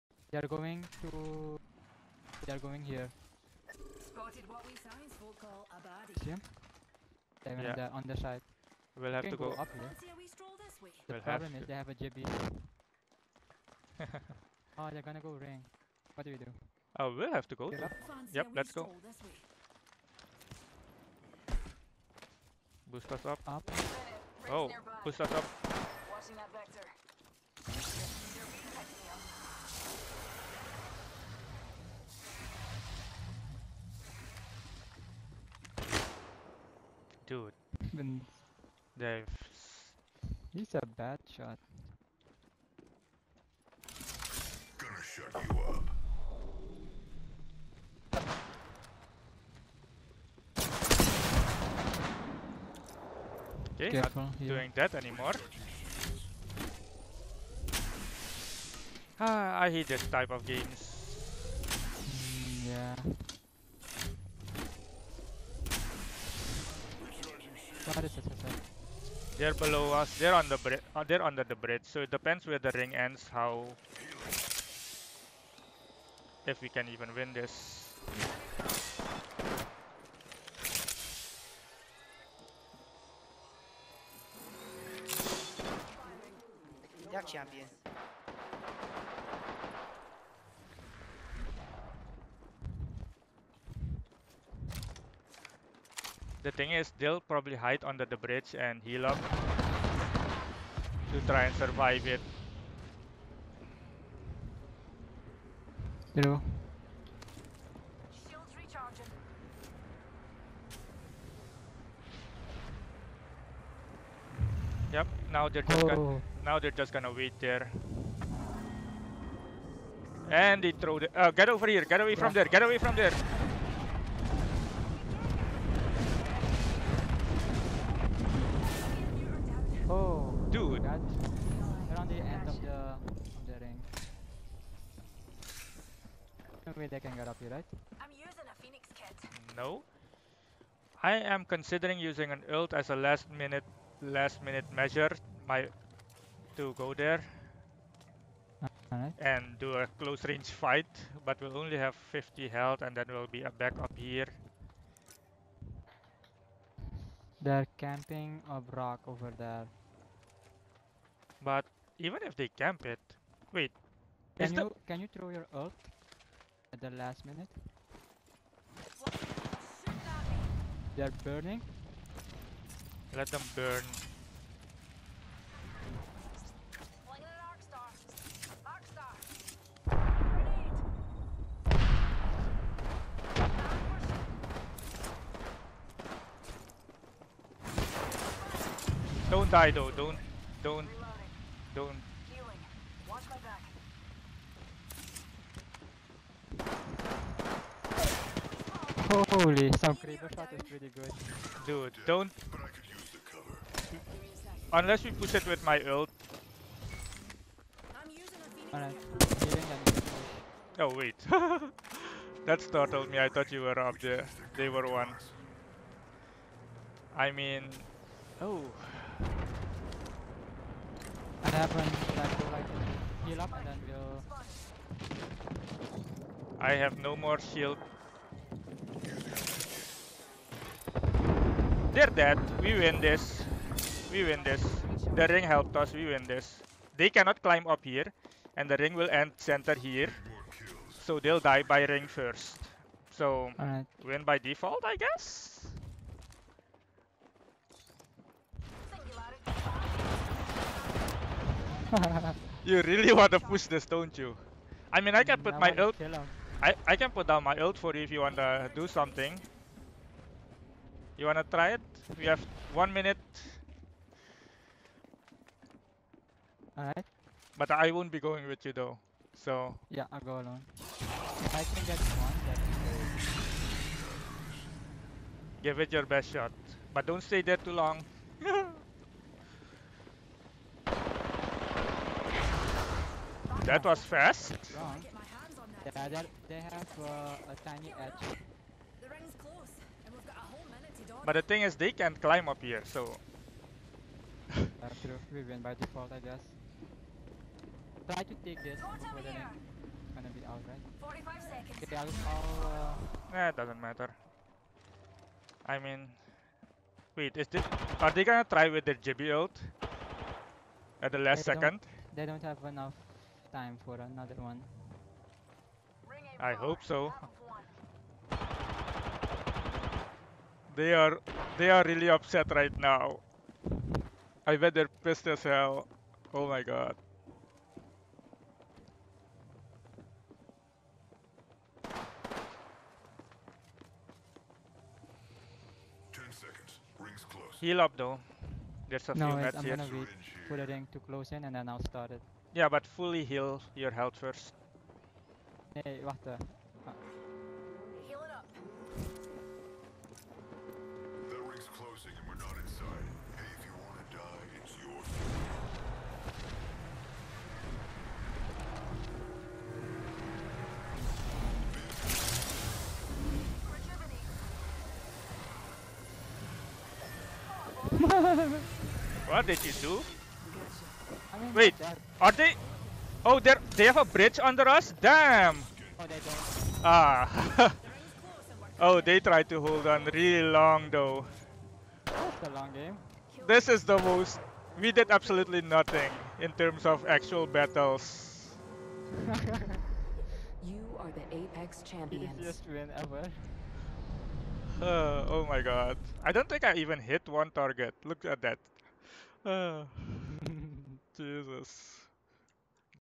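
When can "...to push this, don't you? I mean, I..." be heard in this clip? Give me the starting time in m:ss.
4:13.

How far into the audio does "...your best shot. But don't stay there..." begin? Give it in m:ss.
4:35.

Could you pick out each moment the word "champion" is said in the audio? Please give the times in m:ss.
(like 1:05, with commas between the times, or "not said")
1:27, 6:31.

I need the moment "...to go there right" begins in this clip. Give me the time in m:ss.
2:26.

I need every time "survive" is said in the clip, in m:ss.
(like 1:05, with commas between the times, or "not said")
1:41.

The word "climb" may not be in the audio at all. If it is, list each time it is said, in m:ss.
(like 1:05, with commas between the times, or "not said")
3:57, 4:52.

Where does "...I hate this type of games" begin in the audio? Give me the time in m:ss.
0:59.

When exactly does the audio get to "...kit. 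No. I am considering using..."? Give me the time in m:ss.
2:18.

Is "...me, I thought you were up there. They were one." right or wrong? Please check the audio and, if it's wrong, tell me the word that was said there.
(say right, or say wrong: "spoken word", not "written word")
right.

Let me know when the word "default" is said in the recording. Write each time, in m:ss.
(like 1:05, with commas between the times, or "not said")
4:04, 4:55.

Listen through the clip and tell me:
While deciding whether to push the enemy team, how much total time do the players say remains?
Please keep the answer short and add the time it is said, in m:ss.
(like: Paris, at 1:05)
One minute, at 4:22.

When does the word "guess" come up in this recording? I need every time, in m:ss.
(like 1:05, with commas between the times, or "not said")
4:04, 4:56.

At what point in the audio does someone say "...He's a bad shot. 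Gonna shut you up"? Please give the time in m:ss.
0:40.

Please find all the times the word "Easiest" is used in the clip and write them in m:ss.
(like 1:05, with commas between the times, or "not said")
6:32.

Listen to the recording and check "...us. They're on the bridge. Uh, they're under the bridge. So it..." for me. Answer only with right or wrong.
right.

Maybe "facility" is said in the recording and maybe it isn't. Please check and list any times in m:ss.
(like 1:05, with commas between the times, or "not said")
not said.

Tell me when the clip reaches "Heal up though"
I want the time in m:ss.
5:37.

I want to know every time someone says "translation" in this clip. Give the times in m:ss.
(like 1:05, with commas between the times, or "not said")
not said.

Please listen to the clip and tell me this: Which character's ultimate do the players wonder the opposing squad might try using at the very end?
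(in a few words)
Gibby.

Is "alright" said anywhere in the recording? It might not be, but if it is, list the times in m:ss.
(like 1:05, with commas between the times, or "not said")
3:28, 4:26, 5:00.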